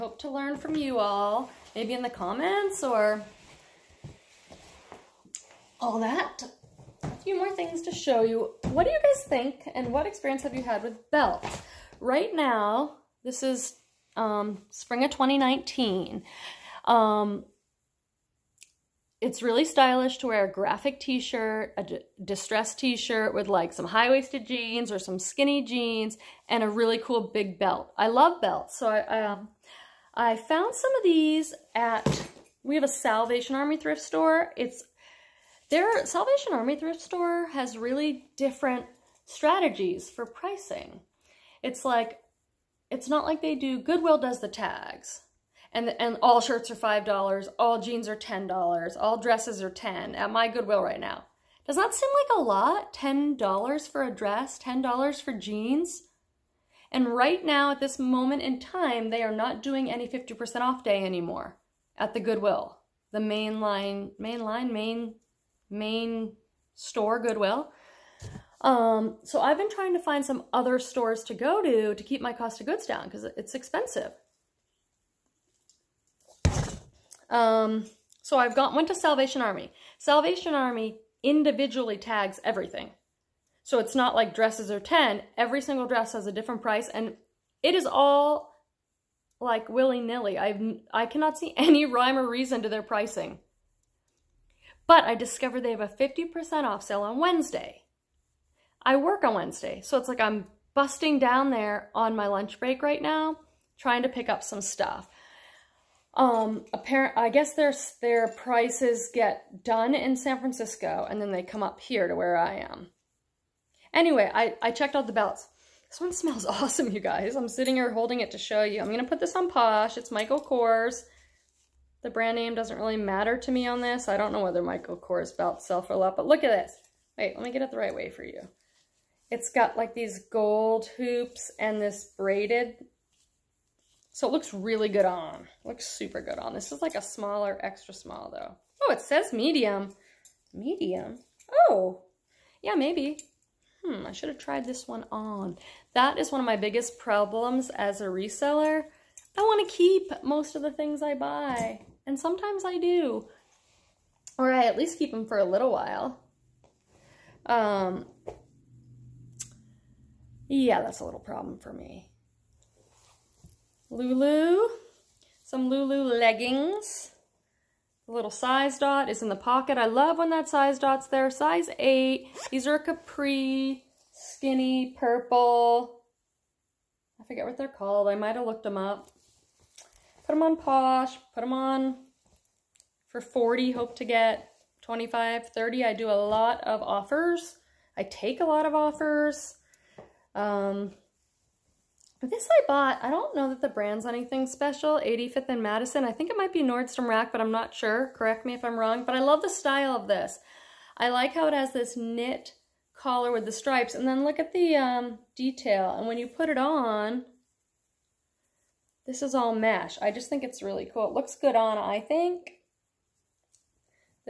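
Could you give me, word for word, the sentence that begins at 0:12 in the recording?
Right now, this is um, spring of 2019.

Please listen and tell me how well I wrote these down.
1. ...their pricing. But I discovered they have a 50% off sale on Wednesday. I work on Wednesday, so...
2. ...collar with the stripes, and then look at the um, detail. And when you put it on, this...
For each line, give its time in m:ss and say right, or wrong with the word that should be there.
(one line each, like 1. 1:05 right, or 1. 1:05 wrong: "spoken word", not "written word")
1. 1:32 right
2. 3:22 right.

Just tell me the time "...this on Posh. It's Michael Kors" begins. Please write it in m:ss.
1:59.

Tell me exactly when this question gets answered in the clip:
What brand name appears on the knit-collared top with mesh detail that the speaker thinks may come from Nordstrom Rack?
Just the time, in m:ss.
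3:15.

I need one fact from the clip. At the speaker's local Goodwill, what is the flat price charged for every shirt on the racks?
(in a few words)
$5.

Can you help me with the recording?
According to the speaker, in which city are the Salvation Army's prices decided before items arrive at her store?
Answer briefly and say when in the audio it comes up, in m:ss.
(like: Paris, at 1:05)
San Francisco, at 1:50.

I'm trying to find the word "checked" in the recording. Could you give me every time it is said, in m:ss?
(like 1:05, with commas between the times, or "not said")
1:54.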